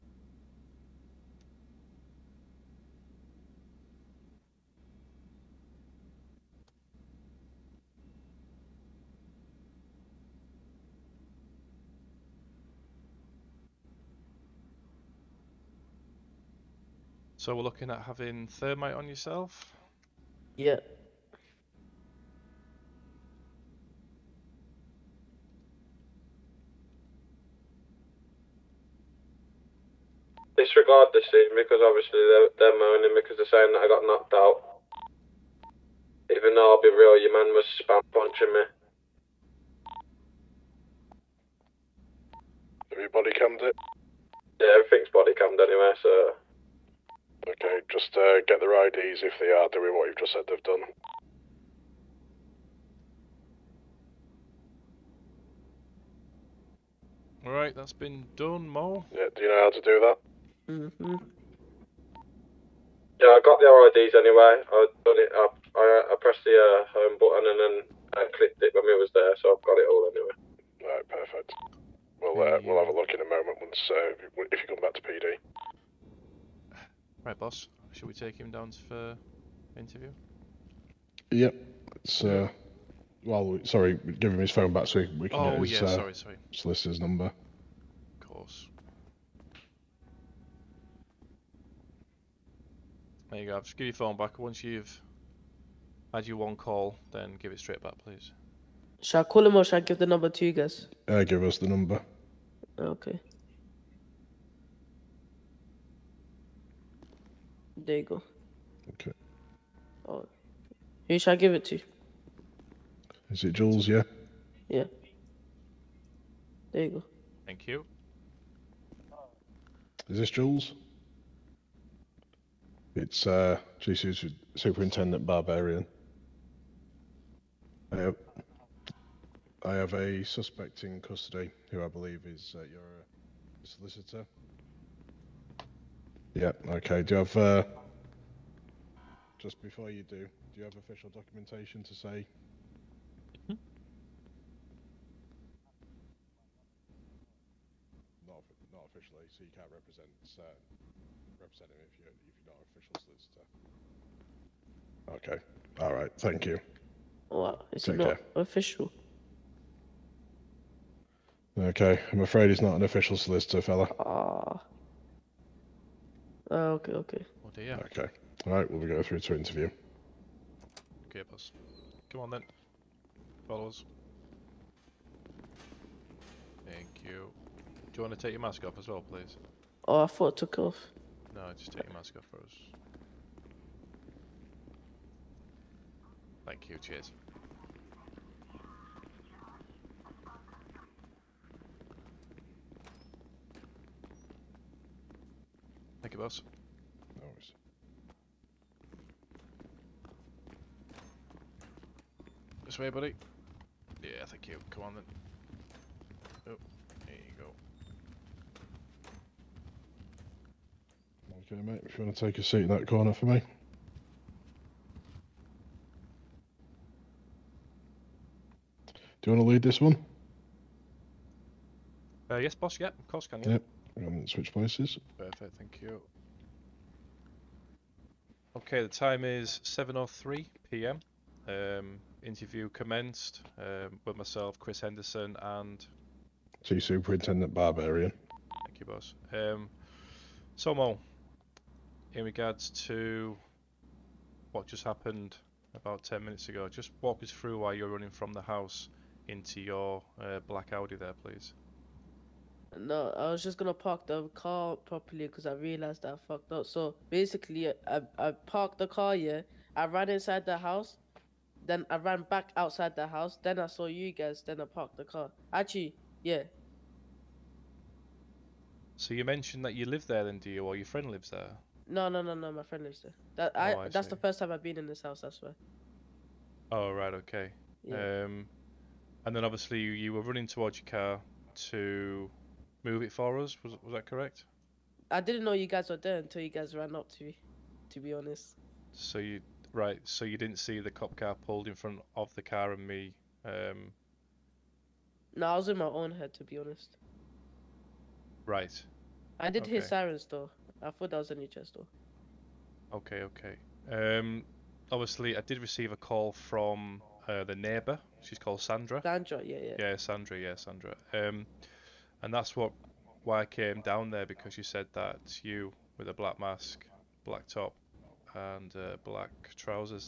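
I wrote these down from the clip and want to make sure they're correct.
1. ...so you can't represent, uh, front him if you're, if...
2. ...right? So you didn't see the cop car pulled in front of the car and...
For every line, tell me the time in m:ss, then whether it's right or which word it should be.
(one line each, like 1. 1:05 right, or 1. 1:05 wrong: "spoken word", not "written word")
1. 2:29 wrong: "represent", not "front"
2. 4:49 right.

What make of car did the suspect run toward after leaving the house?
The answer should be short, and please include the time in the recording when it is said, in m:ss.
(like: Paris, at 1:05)
Audi, at 4:10.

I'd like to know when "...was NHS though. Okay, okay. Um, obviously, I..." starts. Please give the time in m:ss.
5:01.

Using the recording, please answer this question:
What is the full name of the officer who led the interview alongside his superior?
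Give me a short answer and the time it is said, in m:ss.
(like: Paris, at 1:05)
Chris Henderson, at 3:54.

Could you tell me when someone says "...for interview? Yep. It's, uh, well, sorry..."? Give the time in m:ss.
1:18.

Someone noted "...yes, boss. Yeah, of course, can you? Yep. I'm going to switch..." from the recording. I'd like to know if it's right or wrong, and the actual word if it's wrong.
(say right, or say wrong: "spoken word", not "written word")
right.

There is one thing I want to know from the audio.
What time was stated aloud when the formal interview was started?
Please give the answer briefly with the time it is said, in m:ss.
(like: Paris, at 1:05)
7:03 p.m., at 3:49.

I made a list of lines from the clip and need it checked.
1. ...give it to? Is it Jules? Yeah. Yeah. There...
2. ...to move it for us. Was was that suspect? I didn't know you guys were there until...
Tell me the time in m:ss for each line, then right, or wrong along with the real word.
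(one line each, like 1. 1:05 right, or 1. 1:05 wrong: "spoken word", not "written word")
1. 1:51 right
2. 4:41 wrong: "correct", not "suspect".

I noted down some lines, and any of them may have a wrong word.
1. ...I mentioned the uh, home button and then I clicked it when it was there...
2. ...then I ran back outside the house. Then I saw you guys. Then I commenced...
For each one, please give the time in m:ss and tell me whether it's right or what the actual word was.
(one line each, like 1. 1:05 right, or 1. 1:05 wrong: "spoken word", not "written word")
1. 1:06 wrong: "pressed", not "mentioned"
2. 4:21 wrong: "parked", not "commenced".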